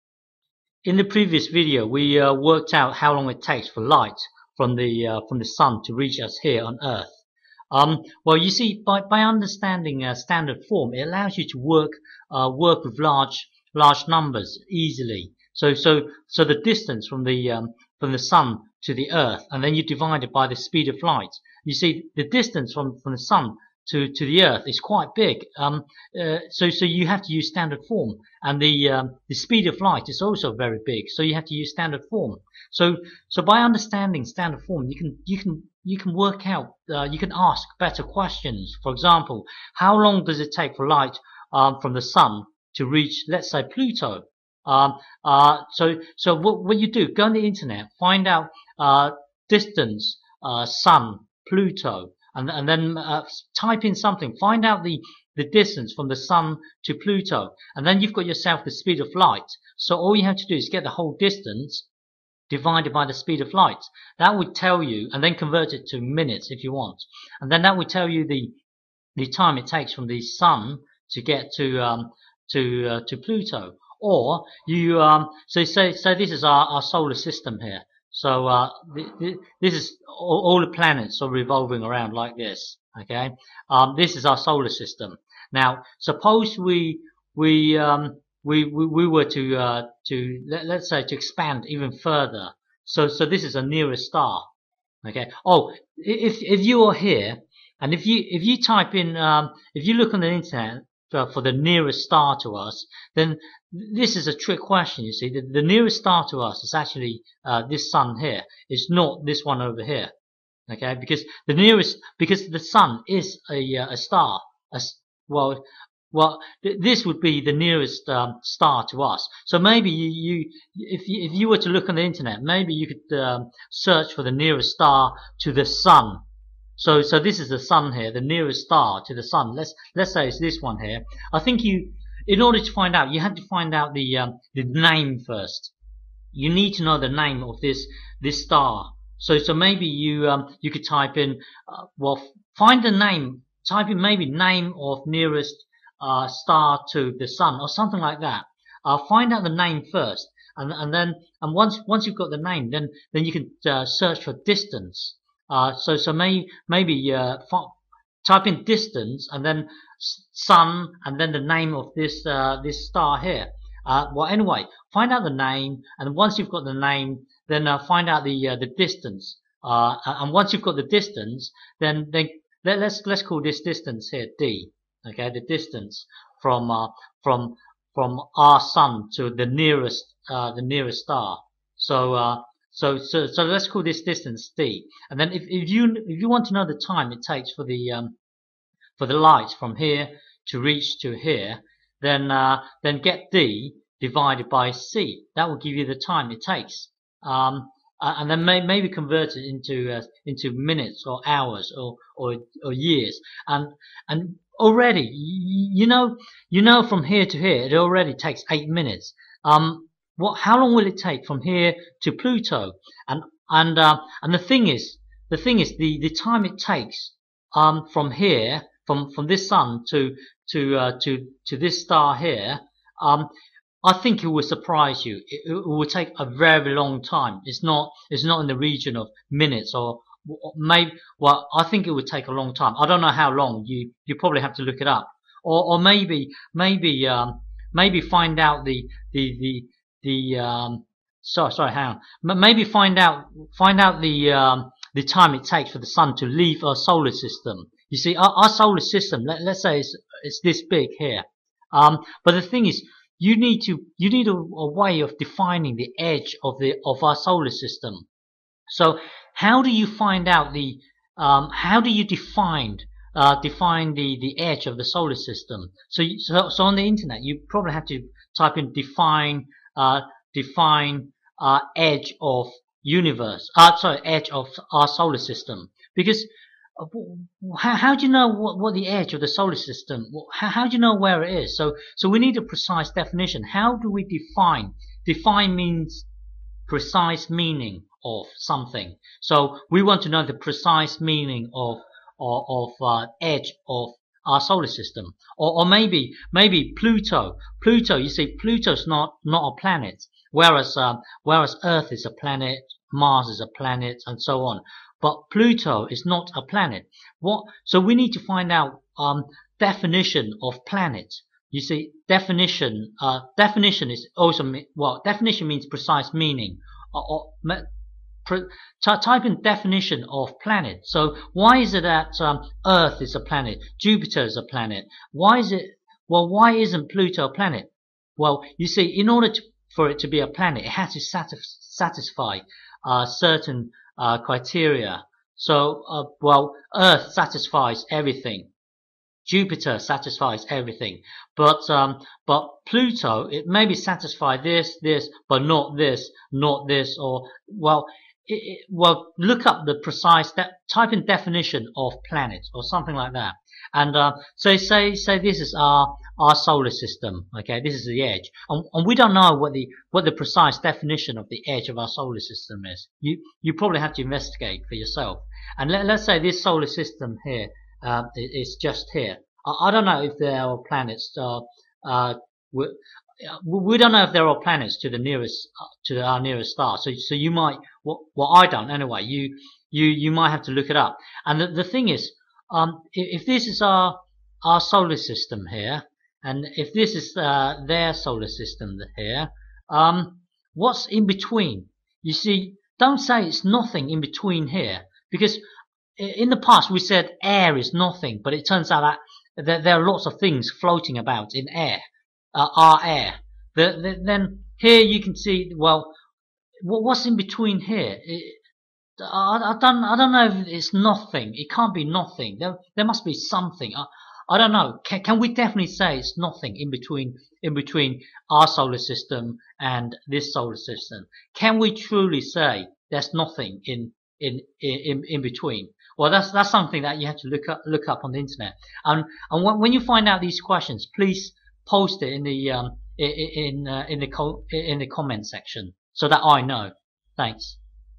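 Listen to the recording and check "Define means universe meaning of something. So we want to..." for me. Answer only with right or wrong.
wrong.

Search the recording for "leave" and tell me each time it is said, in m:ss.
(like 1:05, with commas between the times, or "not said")
4:06.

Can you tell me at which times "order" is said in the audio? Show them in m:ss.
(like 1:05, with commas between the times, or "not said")
2:12, 5:29.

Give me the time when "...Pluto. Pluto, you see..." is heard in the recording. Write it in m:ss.
4:56.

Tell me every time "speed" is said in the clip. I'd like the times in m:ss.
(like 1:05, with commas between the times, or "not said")
0:20, 0:29, 0:58, 1:03.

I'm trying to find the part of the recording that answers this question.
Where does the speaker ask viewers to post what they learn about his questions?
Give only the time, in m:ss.
7:14.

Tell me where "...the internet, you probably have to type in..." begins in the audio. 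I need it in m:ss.
4:26.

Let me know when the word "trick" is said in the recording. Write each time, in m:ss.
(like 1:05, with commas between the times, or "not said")
1:44.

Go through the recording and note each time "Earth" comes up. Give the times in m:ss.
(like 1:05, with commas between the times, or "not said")
0:06, 0:19, 0:24, 5:01, 5:22, 5:36.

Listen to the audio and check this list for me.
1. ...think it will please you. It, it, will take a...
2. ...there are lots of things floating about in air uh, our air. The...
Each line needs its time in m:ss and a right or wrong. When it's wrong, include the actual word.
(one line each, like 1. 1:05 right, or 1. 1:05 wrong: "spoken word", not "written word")
1. 3:43 wrong: "surprise", not "please"
2. 6:39 right.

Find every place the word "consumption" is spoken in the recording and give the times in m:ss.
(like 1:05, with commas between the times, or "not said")
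not said.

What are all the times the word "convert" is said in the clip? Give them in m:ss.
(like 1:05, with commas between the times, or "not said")
1:05, 3:18.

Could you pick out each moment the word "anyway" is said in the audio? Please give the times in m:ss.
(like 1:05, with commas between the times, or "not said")
2:44, 6:18.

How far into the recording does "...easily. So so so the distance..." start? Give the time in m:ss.
0:14.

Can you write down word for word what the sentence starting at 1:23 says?
Okay, um, this is our solar system.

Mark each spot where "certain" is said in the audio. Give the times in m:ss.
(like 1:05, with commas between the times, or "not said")
5:33.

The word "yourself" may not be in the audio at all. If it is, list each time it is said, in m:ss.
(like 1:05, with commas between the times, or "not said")
0:58, 6:04.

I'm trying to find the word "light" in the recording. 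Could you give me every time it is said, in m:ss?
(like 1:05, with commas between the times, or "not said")
0:03, 0:21, 0:29, 0:40, 0:59, 1:03, 3:09.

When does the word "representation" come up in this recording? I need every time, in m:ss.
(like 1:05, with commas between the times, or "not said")
not said.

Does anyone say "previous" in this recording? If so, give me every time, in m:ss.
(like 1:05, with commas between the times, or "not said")
0:01.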